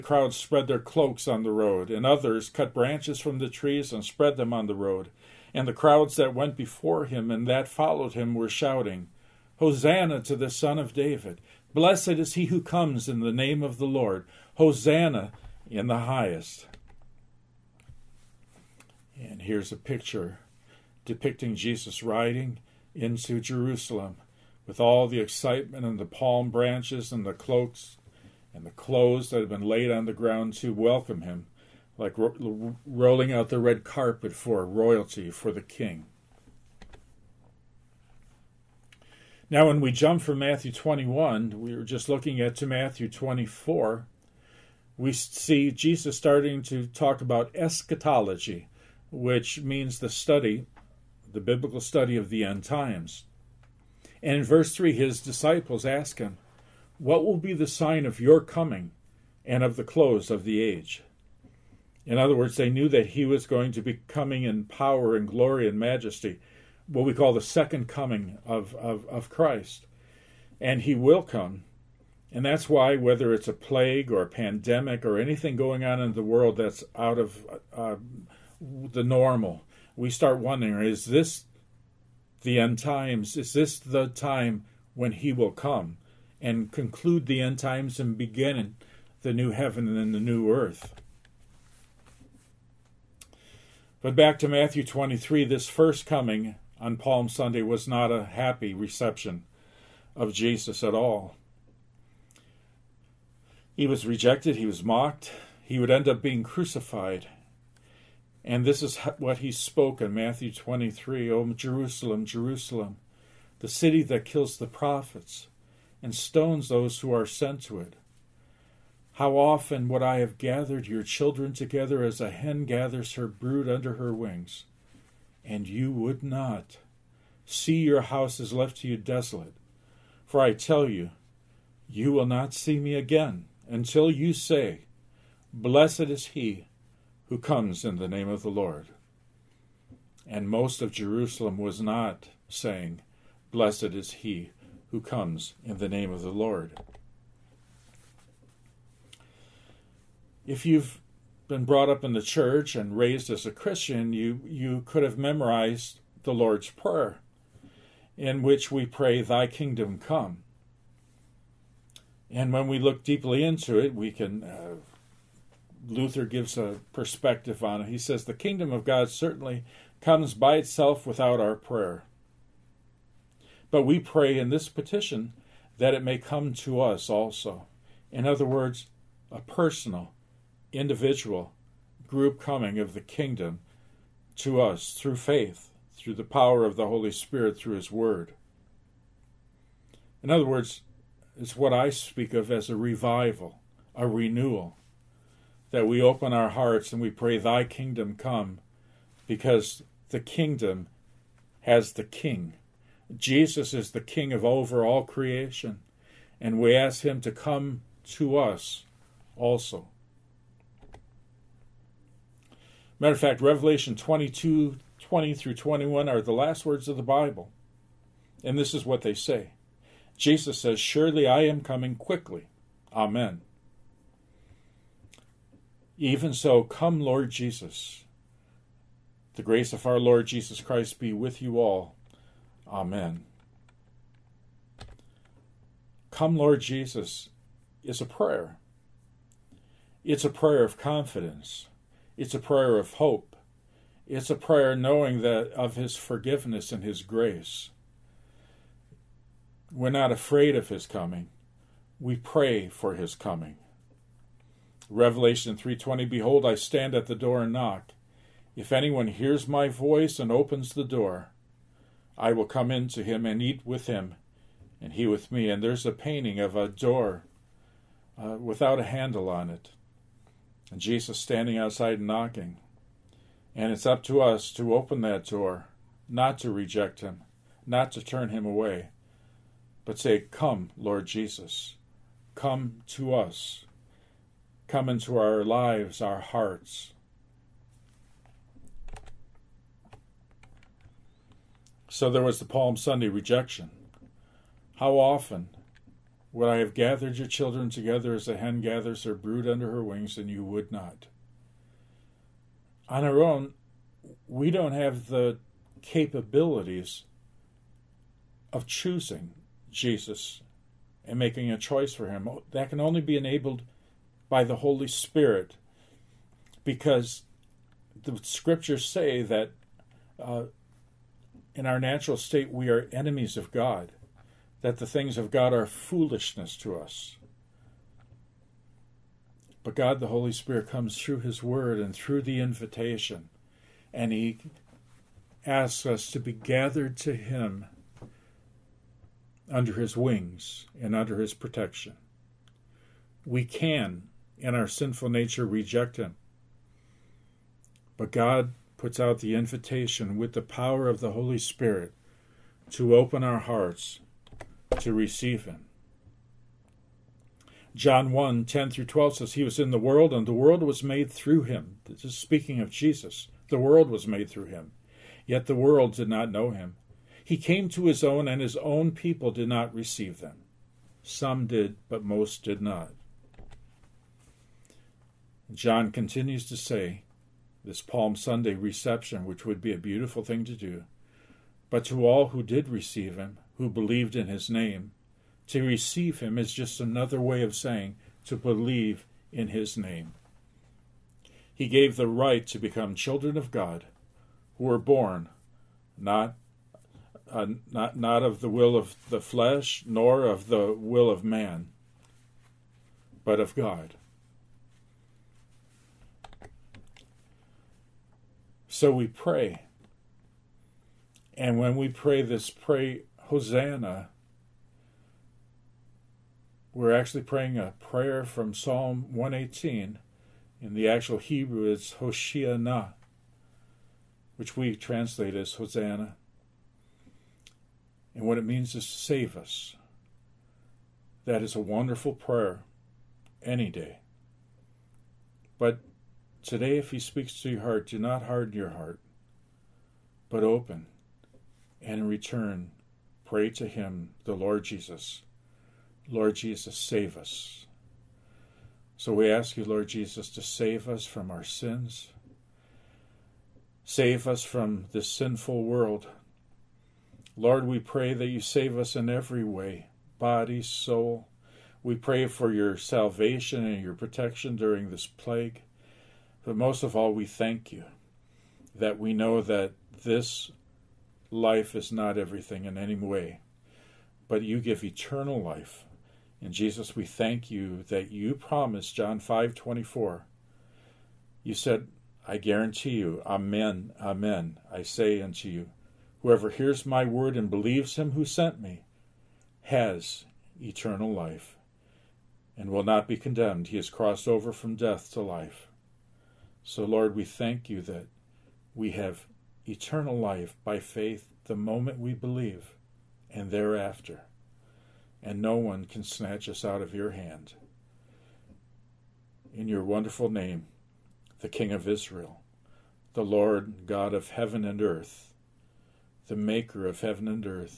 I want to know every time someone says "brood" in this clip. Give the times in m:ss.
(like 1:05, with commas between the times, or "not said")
2:03, 4:59.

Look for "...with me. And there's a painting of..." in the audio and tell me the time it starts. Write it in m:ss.
4:25.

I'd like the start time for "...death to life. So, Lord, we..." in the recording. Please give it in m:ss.
8:14.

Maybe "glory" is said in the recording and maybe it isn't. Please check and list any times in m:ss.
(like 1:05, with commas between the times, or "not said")
1:05.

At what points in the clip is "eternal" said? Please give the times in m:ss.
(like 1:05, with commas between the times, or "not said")
7:54, 8:10, 8:19.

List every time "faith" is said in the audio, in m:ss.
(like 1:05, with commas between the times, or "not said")
3:05, 8:20.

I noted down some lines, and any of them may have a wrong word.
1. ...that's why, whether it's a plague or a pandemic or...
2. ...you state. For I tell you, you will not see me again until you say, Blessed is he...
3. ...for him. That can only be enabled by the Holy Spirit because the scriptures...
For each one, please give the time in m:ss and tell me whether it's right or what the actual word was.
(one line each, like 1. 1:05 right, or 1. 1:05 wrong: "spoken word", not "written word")
1. 1:12 right
2. 2:08 wrong: "desolate", not "state"
3. 5:11 right.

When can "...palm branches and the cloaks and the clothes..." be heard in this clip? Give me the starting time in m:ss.
0:26.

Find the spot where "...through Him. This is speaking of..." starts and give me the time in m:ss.
6:01.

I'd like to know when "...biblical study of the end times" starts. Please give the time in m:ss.
0:51.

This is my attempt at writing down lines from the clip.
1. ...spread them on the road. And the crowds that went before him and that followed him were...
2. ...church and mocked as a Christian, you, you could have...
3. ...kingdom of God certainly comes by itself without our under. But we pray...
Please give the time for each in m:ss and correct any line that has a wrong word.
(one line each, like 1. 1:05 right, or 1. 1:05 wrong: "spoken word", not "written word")
1. 0:04 right
2. 2:32 wrong: "raised", not "mocked"
3. 2:48 wrong: "prayer", not "under".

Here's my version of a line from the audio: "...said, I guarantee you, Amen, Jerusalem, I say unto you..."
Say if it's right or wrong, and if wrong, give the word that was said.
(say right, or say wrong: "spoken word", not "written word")
wrong: "Amen", not "Jerusalem".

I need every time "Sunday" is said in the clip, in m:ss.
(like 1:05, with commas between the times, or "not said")
1:37, 4:52, 6:18.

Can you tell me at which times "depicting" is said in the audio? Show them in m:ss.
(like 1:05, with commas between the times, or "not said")
0:21.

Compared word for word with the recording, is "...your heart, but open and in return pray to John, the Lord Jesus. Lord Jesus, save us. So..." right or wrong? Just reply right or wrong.
wrong.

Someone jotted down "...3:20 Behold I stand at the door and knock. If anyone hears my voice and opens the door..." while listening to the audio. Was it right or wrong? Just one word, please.
right.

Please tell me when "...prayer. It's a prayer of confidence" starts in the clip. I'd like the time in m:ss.
3:58.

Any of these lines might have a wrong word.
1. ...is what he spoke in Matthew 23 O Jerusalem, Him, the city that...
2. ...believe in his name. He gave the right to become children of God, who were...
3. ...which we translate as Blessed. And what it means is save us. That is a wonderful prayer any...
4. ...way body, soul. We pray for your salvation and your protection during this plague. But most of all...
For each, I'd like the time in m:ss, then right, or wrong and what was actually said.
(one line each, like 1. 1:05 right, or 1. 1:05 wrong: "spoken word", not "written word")
1. 1:48 wrong: "Jerusalem", not "Him"
2. 6:28 right
3. 7:04 wrong: "Hosanna", not "Blessed"
4. 7:39 right.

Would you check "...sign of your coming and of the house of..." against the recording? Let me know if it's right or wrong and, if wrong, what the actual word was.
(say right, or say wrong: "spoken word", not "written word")
wrong: "close", not "house".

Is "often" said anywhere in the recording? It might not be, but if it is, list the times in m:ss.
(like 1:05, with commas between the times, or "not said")
1:59, 4:54.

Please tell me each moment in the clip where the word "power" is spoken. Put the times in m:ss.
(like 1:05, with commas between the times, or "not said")
1:04, 3:06, 5:50.